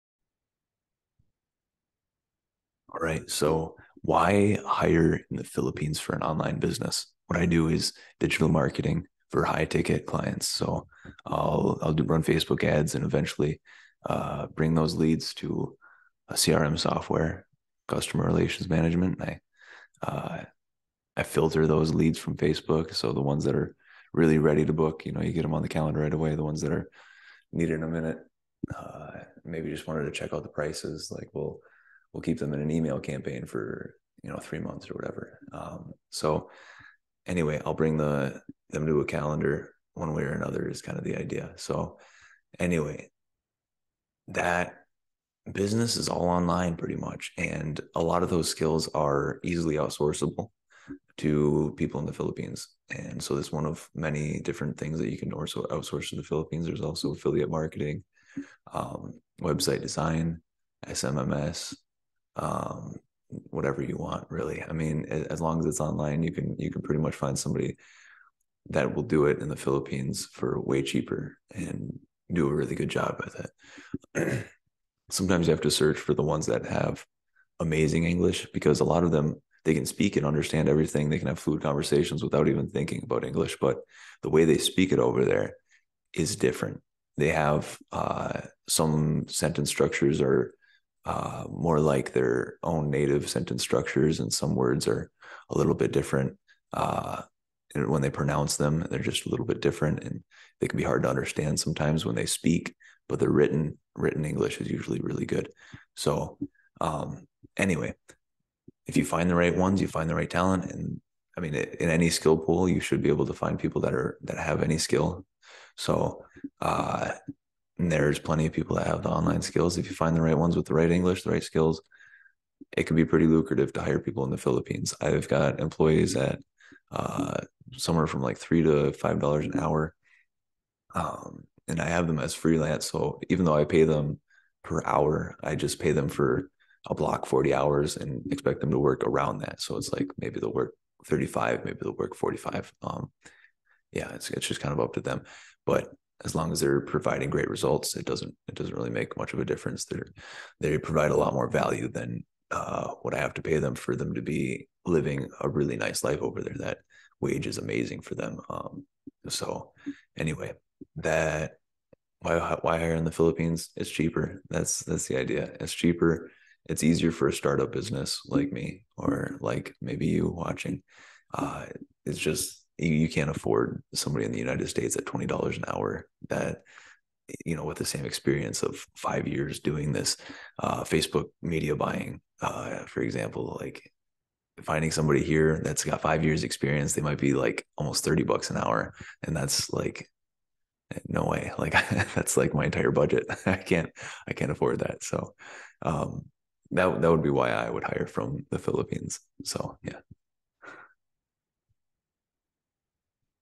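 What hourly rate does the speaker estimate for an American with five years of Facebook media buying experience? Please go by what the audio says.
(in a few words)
$30.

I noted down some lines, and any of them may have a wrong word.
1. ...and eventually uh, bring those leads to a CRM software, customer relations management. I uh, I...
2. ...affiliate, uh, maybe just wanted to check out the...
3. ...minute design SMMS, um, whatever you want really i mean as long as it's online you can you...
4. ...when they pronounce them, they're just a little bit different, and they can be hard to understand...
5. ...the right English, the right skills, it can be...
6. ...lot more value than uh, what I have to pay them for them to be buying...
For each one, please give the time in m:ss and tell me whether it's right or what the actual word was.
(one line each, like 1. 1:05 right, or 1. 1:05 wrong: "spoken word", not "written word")
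1. 0:12 right
2. 0:27 wrong: "minute", not "affiliate"
3. 0:59 wrong: "website", not "minute"
4. 1:37 right
5. 2:00 right
6. 2:31 wrong: "living", not "buying".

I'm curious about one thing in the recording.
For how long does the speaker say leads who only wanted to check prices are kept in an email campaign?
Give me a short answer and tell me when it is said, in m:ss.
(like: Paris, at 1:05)
3 months, at 0:34.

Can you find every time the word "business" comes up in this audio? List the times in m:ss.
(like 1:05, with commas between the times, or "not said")
0:06, 0:45, 2:47.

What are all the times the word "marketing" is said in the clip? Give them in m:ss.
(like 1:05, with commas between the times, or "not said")
0:08, 0:57.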